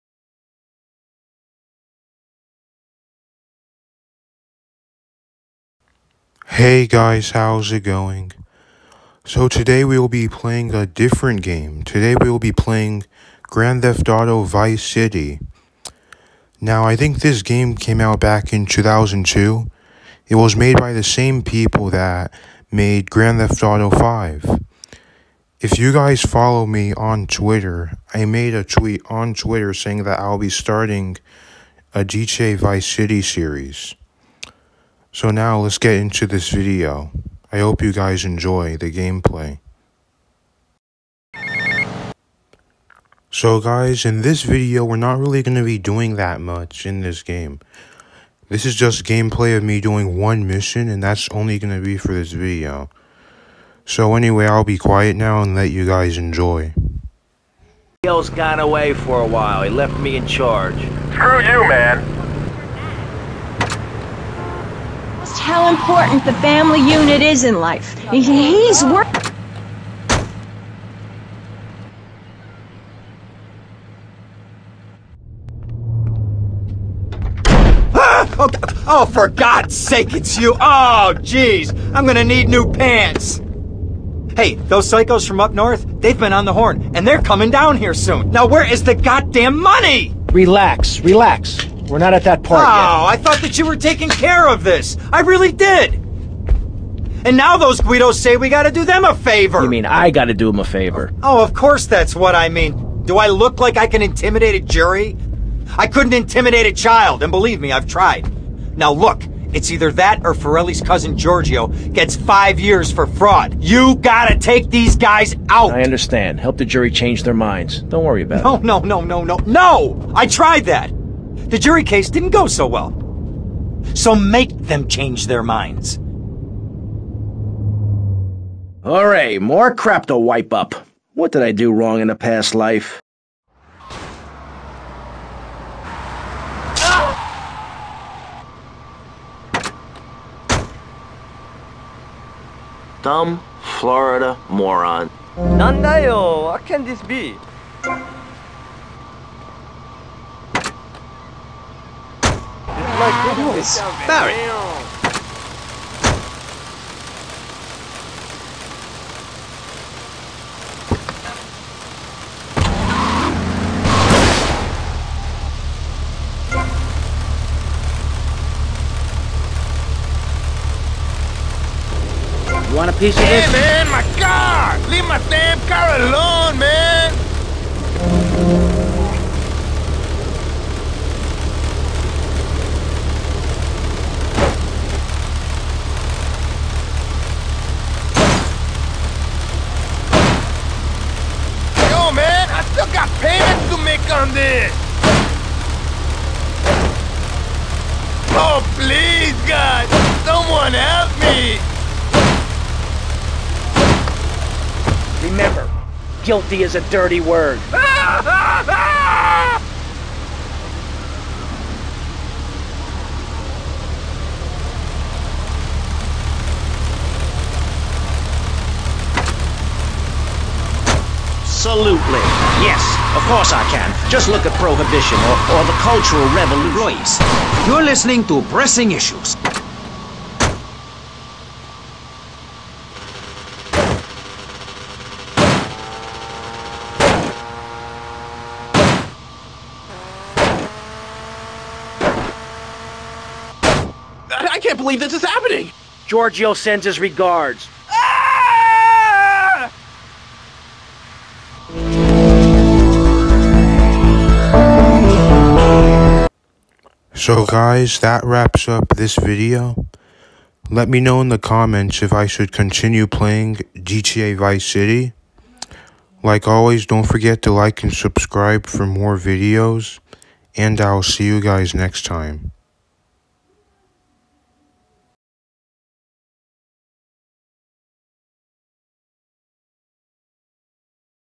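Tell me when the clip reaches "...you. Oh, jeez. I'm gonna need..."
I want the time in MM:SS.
01:20.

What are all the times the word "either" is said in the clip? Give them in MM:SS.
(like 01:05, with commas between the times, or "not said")
01:49.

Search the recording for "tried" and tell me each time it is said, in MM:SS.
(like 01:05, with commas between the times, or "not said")
01:47, 02:00.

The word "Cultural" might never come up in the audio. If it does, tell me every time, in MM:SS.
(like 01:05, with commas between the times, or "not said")
03:45.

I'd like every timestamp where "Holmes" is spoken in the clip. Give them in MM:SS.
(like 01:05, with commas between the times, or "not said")
not said.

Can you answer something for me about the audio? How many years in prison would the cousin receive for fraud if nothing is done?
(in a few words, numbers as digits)
5.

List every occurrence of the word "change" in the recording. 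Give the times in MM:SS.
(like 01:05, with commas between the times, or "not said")
01:56, 02:04.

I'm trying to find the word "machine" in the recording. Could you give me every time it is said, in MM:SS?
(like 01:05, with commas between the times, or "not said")
not said.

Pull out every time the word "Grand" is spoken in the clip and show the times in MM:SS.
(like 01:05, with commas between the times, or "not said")
00:13, 00:23.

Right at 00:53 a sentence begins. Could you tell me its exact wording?
So anyway, I'll be quiet now and let you guys enjoy.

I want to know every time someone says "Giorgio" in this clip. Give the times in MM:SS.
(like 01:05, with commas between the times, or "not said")
01:51, 04:06.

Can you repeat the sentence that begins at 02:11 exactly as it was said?
What did I do wrong in a past life?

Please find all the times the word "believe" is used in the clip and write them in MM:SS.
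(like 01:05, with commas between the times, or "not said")
01:47, 04:04.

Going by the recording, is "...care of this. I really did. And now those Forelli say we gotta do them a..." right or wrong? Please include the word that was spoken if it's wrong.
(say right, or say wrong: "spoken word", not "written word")
wrong: "Guidos", not "Forelli".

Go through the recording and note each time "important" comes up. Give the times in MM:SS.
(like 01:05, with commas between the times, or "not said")
01:05.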